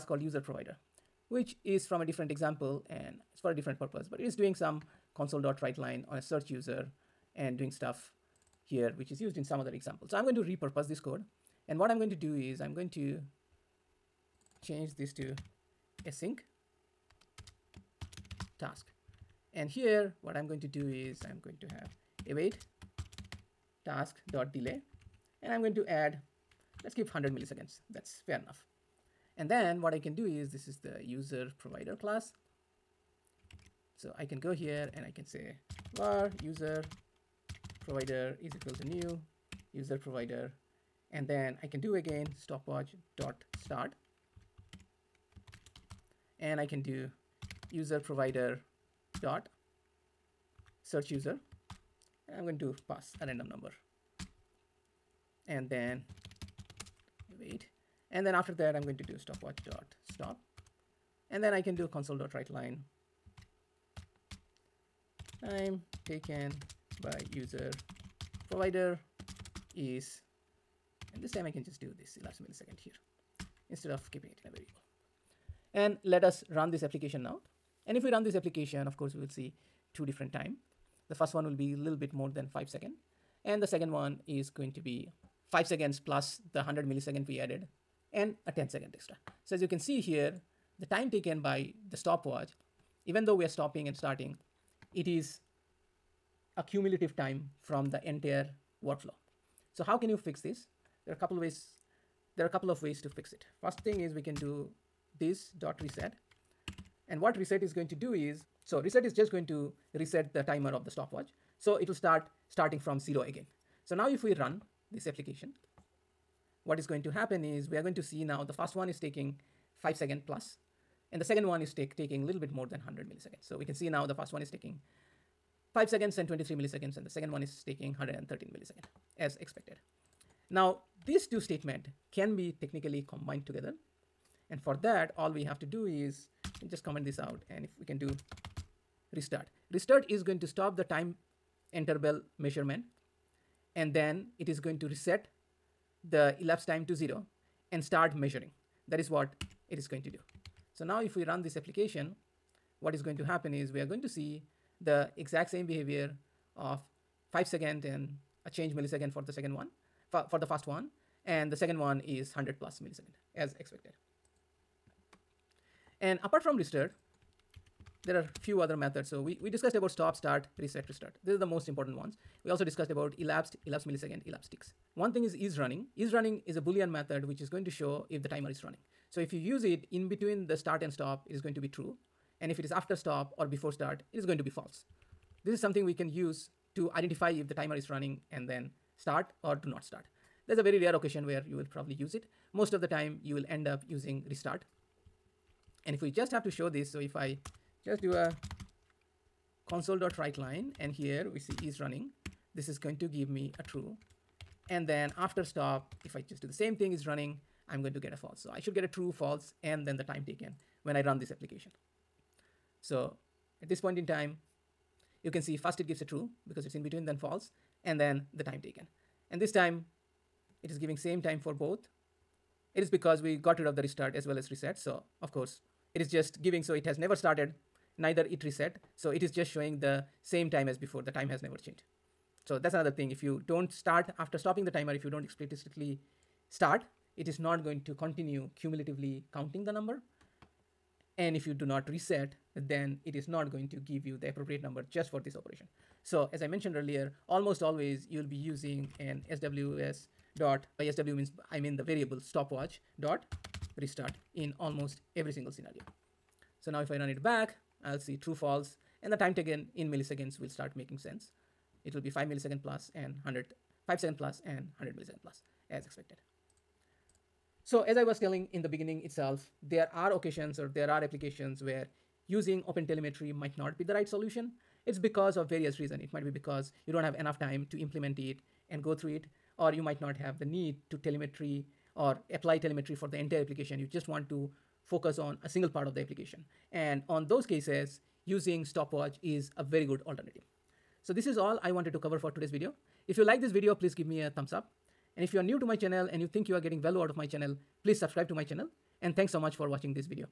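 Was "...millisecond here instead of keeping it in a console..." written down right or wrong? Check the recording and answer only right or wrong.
wrong.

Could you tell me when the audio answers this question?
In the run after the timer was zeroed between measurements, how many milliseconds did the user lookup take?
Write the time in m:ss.
2:07.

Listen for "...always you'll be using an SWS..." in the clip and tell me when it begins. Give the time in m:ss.
4:07.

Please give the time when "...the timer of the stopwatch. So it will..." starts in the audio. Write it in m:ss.
1:50.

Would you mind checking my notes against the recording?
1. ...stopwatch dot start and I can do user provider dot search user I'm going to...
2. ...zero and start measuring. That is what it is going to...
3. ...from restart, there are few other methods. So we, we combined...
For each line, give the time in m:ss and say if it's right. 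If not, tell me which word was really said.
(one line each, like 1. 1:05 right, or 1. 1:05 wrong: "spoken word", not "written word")
1. 0:42 right
2. 2:26 right
3. 2:46 wrong: "discussed", not "combined".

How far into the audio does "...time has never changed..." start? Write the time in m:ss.
3:51.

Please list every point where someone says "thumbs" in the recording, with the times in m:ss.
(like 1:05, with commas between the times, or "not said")
4:54.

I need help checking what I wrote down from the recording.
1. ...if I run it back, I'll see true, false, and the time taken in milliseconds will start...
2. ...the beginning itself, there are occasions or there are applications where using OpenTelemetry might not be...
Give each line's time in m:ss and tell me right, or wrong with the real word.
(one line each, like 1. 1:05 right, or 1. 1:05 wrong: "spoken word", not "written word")
1. 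4:16 right
2. 4:28 right.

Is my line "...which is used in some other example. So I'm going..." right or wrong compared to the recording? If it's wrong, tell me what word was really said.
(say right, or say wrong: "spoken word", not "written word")
right.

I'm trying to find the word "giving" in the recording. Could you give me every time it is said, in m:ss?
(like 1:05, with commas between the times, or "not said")
3:40, 3:46.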